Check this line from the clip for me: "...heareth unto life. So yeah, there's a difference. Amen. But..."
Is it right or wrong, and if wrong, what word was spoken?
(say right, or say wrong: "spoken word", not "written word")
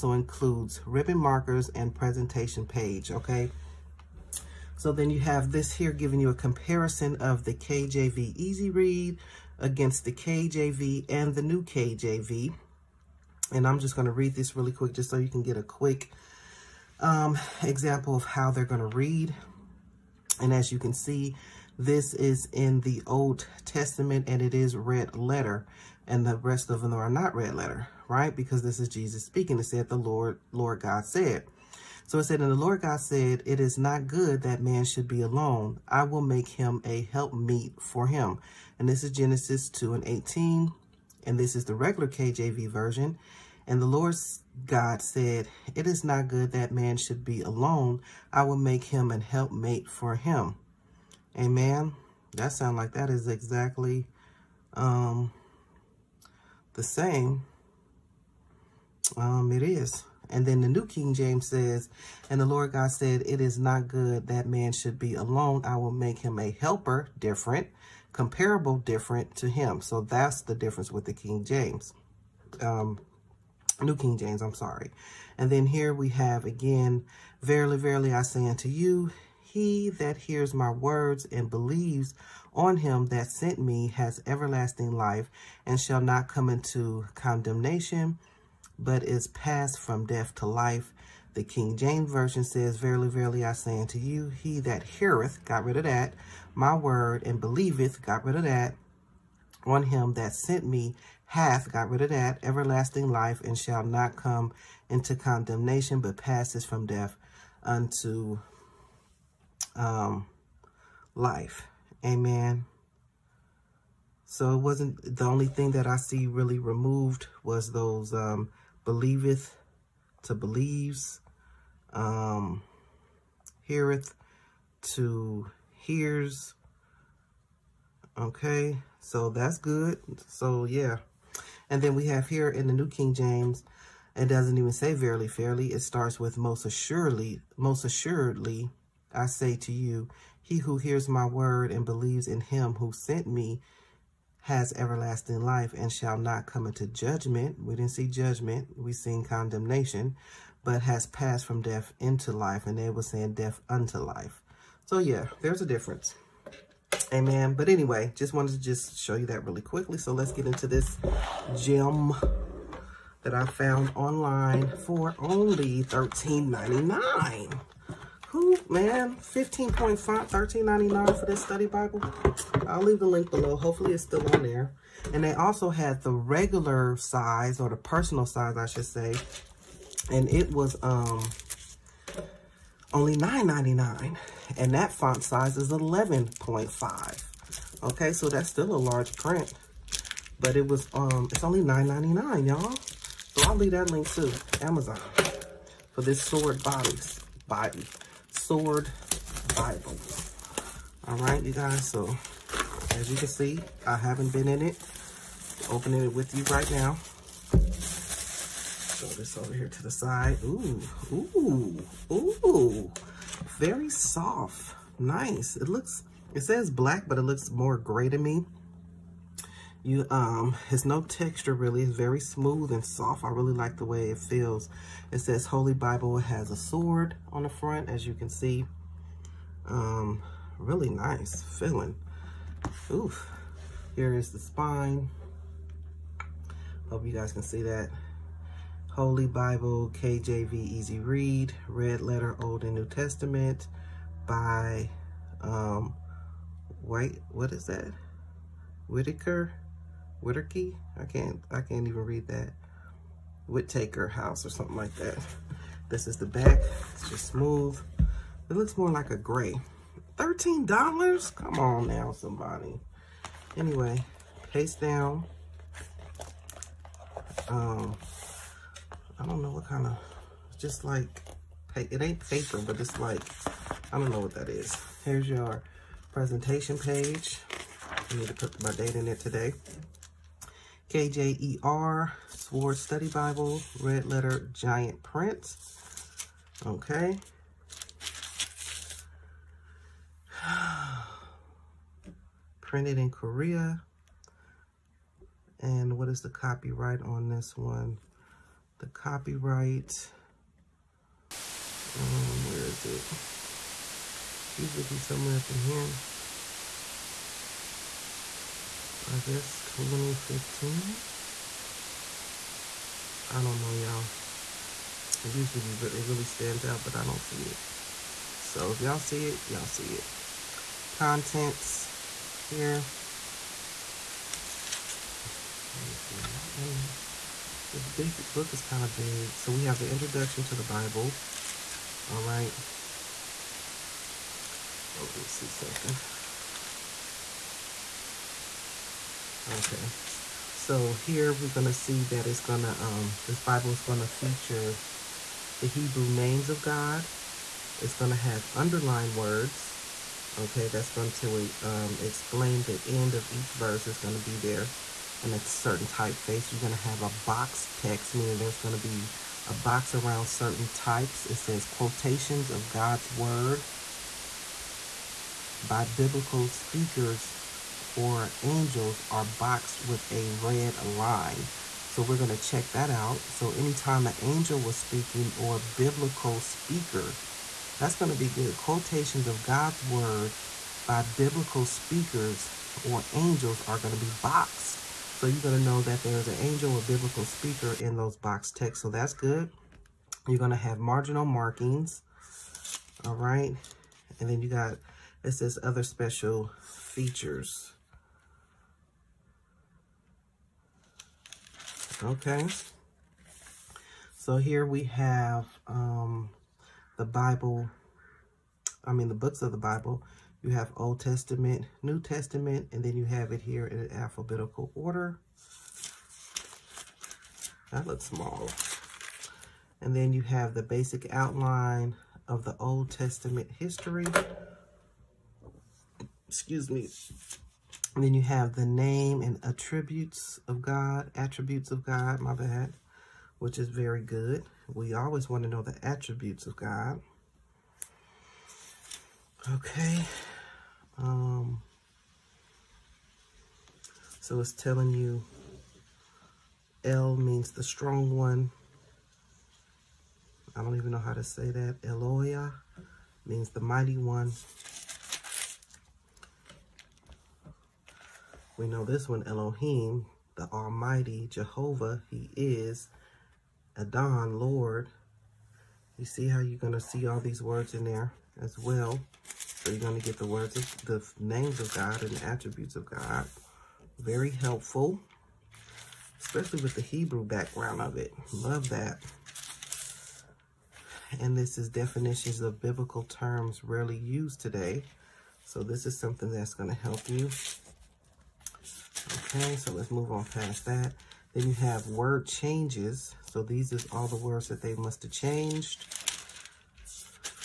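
wrong: "death", not "heareth".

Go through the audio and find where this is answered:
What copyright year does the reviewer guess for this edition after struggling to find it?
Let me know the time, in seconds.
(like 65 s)
309 s.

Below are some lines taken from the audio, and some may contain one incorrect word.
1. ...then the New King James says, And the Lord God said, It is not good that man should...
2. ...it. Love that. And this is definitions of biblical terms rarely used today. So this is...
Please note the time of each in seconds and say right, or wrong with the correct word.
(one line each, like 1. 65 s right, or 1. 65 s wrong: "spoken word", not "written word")
1. 60 s right
2. 477 s right.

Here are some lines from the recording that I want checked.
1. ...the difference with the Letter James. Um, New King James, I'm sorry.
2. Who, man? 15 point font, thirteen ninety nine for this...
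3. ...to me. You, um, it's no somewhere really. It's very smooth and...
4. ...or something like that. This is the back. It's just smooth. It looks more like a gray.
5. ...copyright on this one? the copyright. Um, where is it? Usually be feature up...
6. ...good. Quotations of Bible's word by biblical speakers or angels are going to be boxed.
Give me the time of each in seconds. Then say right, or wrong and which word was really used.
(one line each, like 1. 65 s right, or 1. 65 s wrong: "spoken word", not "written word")
1. 70 s wrong: "King", not "Letter"
2. 168 s right
3. 218 s wrong: "texture", not "somewhere"
4. 254 s right
5. 296 s wrong: "somewhere", not "feature"
6. 378 s wrong: "God", not "Bible".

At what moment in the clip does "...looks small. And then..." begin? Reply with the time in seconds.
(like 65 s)
417 s.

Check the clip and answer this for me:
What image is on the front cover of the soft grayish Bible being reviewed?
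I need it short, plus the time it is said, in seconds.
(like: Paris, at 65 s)
A sword, at 226 s.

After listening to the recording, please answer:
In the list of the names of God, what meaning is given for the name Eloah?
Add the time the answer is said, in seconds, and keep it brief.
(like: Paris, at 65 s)
The mighty one, at 453 s.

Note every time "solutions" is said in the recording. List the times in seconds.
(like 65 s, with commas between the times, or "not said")
not said.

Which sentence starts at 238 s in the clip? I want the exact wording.
Holy Bible, KJV Easy Read, Red Letter Old and New Testament by um, White, what is that?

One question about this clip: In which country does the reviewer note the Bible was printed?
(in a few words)
Korea.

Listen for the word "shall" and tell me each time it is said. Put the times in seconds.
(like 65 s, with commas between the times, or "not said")
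85 s, 103 s, 145 s.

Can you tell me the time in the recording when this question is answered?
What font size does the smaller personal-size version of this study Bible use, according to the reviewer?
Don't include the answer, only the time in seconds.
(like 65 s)
185 s.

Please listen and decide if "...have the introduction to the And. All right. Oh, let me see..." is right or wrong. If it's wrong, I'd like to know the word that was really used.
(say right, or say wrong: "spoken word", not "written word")
wrong: "Bible", not "And".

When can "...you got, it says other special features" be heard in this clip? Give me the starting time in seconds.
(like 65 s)
394 s.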